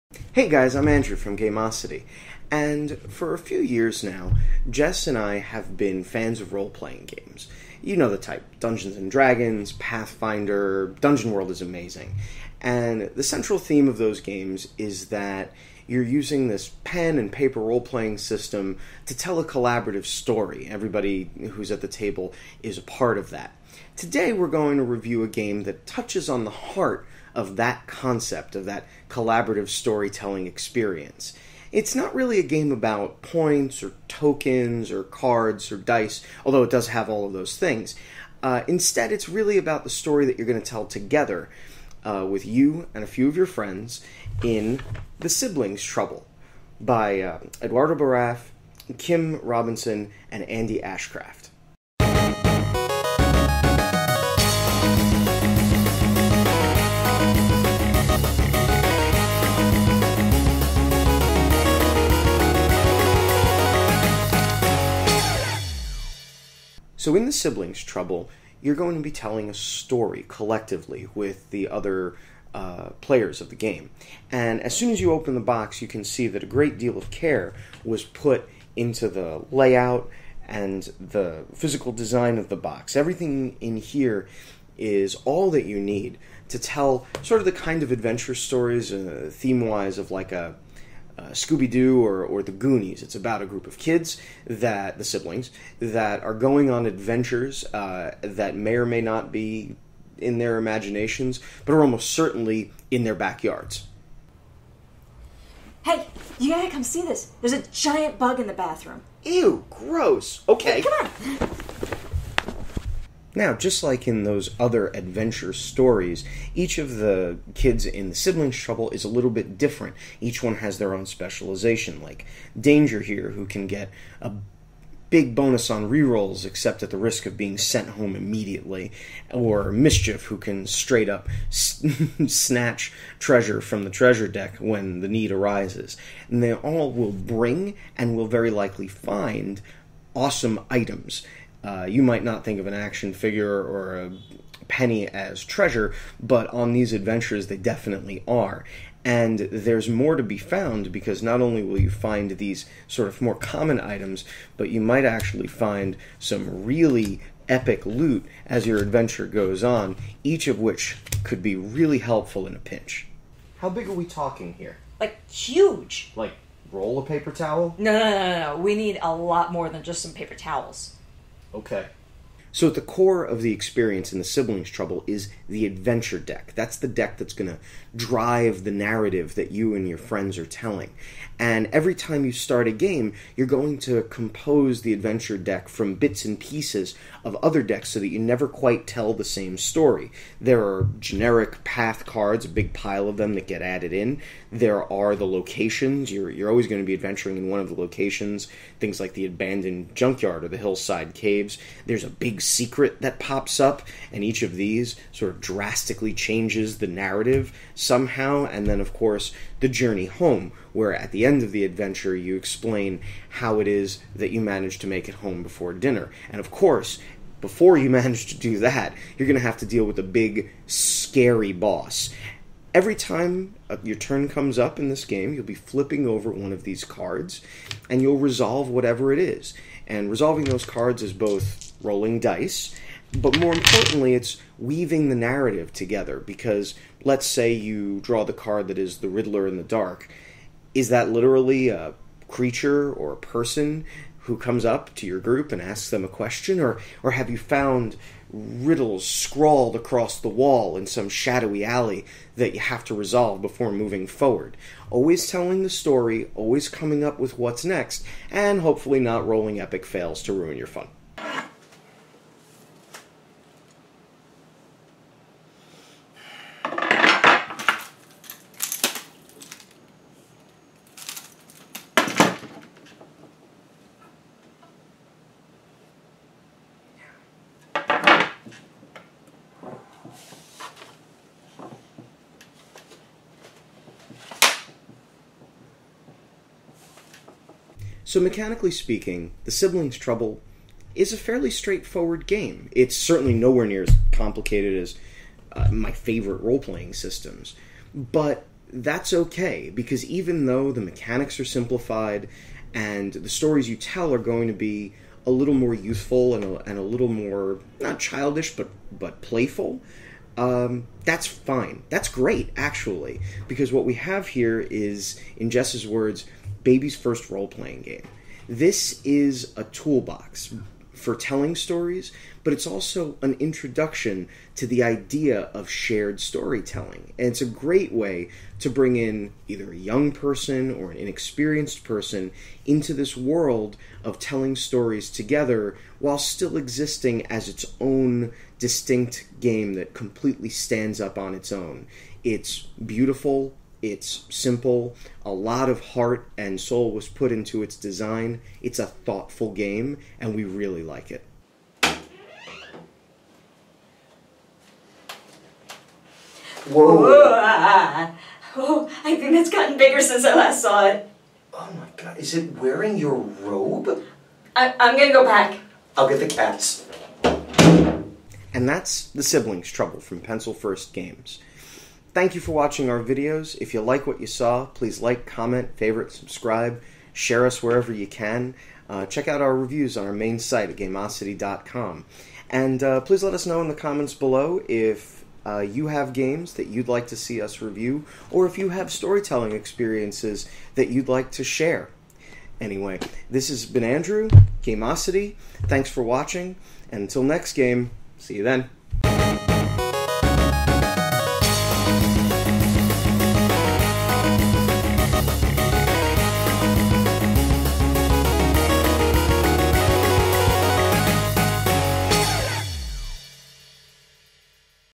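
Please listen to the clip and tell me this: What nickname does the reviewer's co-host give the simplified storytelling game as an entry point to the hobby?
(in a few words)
baby's first role playing game.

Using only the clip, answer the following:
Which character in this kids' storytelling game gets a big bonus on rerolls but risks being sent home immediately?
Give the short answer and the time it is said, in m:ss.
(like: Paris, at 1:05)
Danger, at 2:02.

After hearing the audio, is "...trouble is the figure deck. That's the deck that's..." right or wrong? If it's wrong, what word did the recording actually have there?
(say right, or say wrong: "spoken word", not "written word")
wrong: "adventure", not "figure".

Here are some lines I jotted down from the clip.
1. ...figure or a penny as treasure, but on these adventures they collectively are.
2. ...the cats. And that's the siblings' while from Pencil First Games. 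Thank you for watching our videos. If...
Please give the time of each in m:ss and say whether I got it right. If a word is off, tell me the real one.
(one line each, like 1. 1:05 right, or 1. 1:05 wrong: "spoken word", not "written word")
1. 2:23 wrong: "definitely", not "collectively"
2. 6:06 wrong: "trouble", not "while".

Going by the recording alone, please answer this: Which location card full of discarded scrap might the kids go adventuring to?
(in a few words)
abandoned junkyard.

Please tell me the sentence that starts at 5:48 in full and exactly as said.
It's a thoughtful game, and we really like it.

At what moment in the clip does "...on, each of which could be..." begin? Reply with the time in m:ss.
2:39.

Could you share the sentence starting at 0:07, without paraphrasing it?
You know the type Dungeons and Dragons, Pathfinder, Dungeon World is amazing.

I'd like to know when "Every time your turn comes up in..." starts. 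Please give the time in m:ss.
3:42.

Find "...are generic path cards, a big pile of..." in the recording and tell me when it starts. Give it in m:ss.
3:10.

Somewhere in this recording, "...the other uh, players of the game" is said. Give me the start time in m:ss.
1:11.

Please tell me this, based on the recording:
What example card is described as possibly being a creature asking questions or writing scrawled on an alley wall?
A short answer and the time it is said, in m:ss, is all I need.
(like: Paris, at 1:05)
Riddler in the dark, at 3:59.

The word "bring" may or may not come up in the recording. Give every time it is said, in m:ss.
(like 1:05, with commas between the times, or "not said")
2:17, 5:28.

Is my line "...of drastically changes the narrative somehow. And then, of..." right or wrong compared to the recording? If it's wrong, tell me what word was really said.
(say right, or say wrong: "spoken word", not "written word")
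right.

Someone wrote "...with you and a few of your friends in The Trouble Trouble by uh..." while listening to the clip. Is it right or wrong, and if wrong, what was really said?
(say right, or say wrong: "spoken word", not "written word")
wrong: "Siblings", not "Trouble".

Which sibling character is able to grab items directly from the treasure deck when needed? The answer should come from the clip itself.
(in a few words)
Mischief.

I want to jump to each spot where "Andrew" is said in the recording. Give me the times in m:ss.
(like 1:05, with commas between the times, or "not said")
0:00, 6:33.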